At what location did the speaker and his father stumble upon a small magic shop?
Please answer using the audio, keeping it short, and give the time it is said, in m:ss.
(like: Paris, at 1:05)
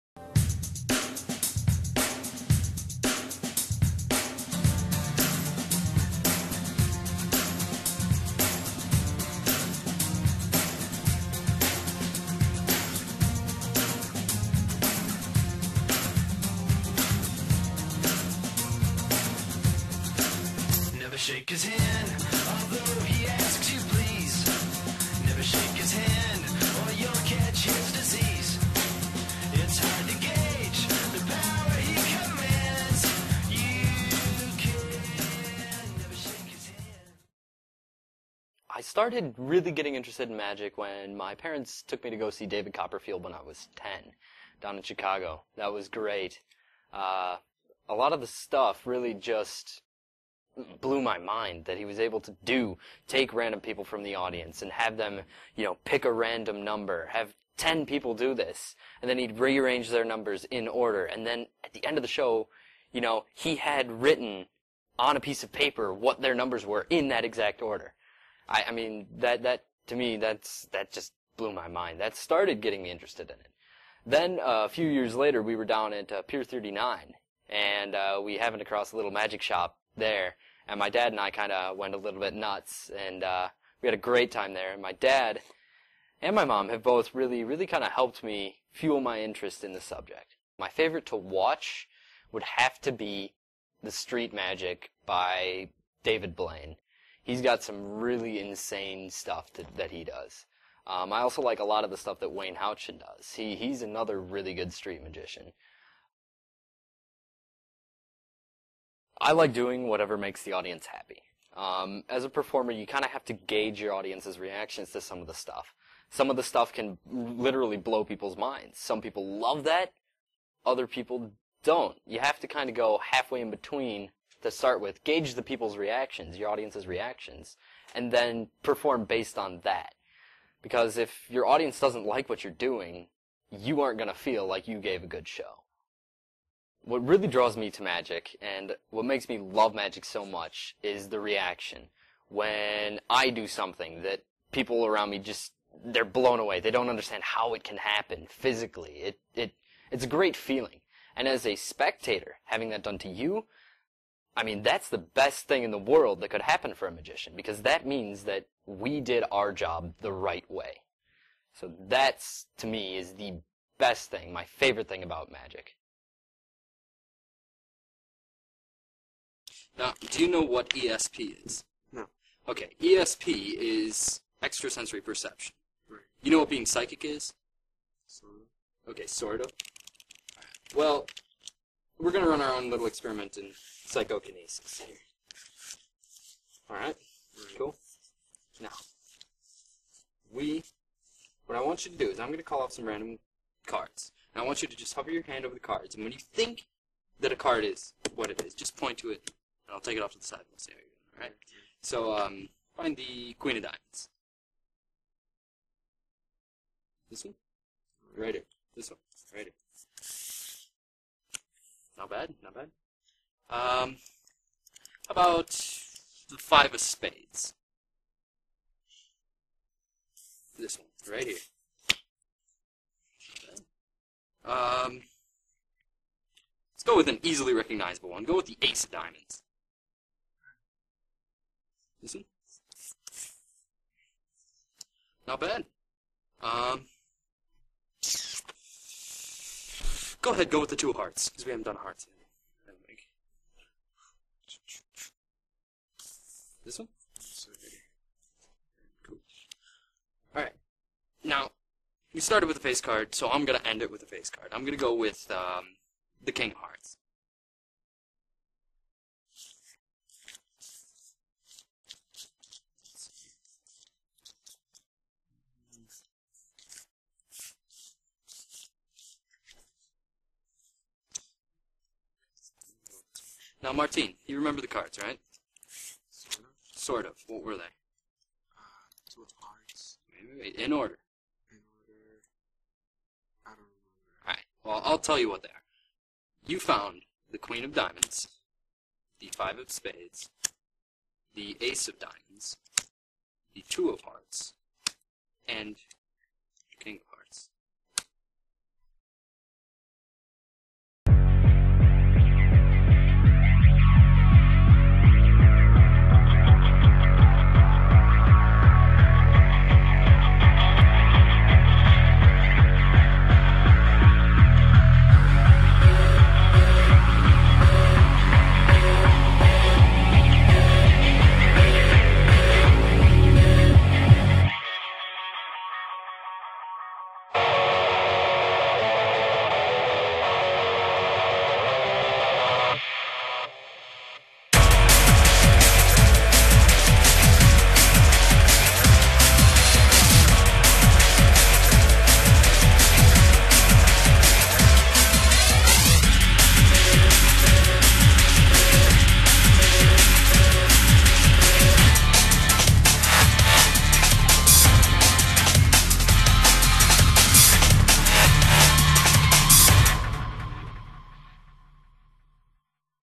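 Pier 39, at 1:16.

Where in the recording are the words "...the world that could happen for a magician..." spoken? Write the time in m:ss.
2:35.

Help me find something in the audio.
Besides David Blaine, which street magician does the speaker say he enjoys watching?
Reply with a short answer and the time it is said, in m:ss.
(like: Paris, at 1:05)
Wayne Houchin, at 1:42.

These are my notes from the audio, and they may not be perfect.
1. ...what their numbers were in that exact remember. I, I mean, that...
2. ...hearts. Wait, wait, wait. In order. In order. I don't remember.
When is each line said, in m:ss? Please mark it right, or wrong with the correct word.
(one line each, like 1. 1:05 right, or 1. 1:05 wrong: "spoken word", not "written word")
1. 1:05 wrong: "order", not "remember"
2. 4:39 right.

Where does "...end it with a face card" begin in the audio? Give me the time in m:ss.
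4:13.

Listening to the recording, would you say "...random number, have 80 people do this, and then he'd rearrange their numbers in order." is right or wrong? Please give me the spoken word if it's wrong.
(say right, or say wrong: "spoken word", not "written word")
wrong: "10", not "80".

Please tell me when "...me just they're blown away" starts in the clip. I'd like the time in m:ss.
2:25.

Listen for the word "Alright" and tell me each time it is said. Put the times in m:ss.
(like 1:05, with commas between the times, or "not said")
3:06, 4:10, 4:44.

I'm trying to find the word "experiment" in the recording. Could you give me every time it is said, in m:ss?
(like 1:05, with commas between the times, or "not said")
3:02.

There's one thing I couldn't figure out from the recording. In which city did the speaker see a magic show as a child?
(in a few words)
Chicago.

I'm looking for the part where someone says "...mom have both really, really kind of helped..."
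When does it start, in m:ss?
1:26.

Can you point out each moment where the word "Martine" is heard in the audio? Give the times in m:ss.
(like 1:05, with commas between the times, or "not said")
4:33.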